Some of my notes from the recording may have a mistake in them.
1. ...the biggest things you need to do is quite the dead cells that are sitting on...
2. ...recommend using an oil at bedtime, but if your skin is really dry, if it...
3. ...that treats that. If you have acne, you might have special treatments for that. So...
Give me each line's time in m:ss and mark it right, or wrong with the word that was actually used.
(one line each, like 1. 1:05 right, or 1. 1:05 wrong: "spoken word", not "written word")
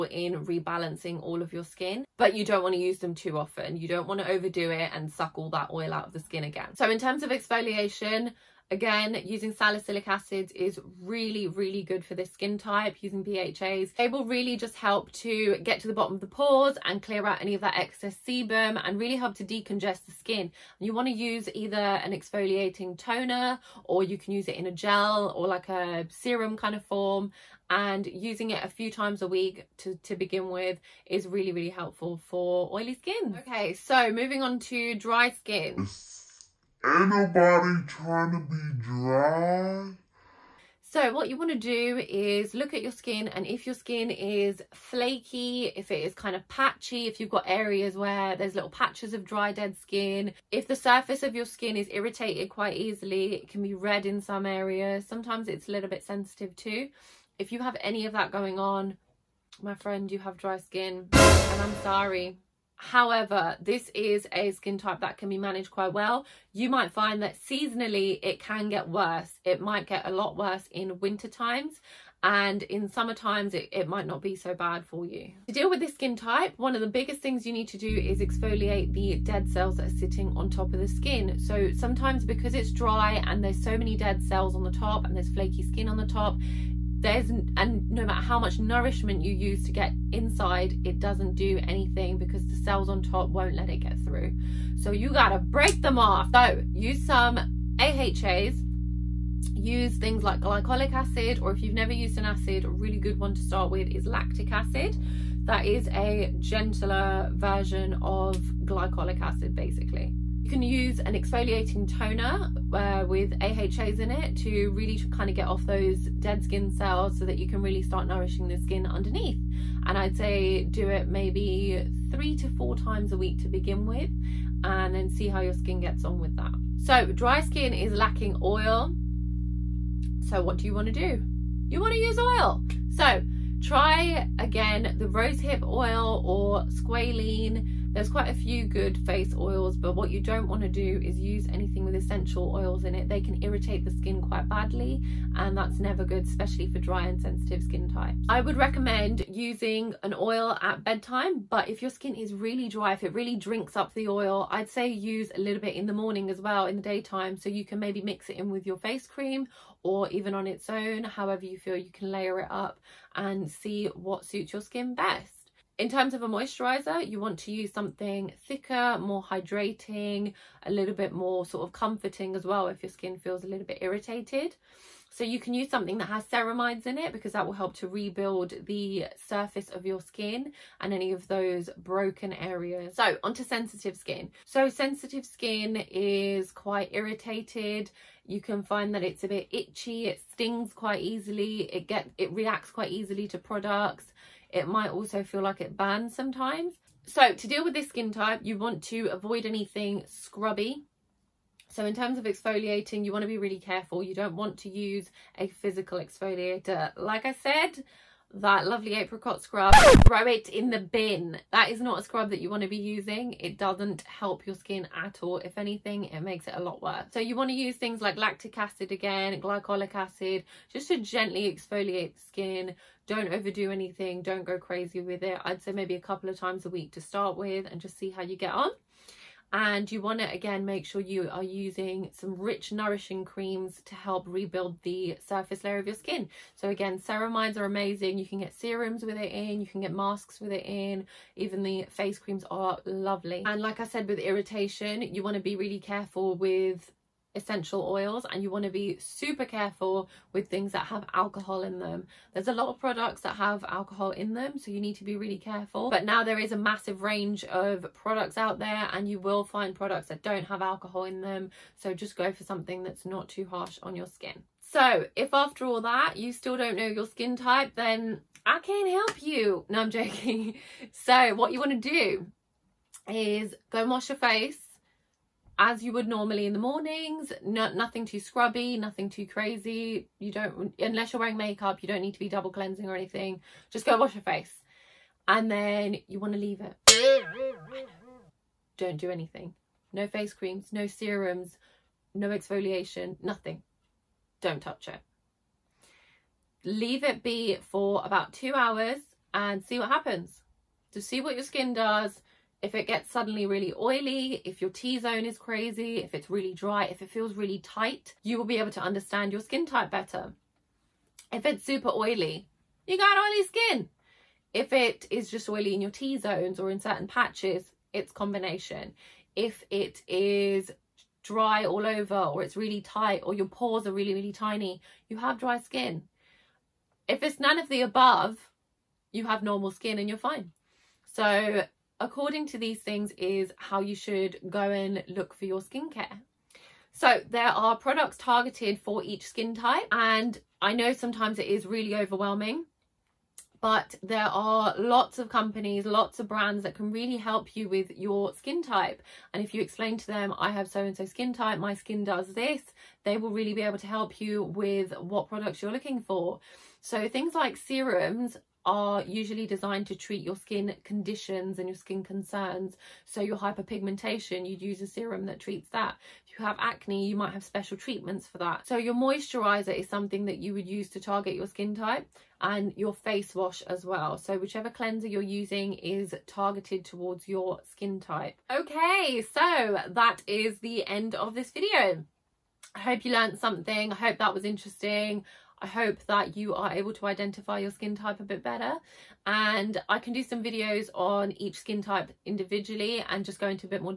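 1. 1:16 wrong: "exfoliate", not "quite"
2. 2:28 right
3. 6:05 right.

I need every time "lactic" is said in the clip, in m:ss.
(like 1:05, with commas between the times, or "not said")
1:44, 3:38.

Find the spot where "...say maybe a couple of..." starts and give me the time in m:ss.
3:45.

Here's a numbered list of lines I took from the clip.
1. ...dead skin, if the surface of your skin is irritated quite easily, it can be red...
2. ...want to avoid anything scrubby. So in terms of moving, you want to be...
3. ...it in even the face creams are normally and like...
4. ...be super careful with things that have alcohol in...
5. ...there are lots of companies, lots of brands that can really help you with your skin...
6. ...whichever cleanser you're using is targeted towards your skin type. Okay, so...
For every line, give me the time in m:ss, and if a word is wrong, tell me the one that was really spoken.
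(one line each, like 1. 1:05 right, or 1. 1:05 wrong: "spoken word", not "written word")
1. 0:49 right
2. 3:18 wrong: "exfoliating", not "moving"
3. 4:00 wrong: "lovely", not "normally"
4. 4:08 right
5. 5:44 right
6. 6:14 right.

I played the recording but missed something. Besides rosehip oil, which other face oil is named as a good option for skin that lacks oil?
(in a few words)
squalene.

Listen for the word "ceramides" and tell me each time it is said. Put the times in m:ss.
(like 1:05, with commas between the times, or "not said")
2:56, 3:56.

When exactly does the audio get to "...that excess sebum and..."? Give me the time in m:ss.
0:17.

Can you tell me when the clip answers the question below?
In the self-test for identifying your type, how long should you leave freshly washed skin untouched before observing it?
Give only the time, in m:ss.
4:58.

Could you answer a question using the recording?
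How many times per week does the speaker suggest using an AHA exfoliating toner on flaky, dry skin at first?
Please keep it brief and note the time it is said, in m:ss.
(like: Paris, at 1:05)
3 to 4, at 2:02.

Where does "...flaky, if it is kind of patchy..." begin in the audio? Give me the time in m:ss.
0:44.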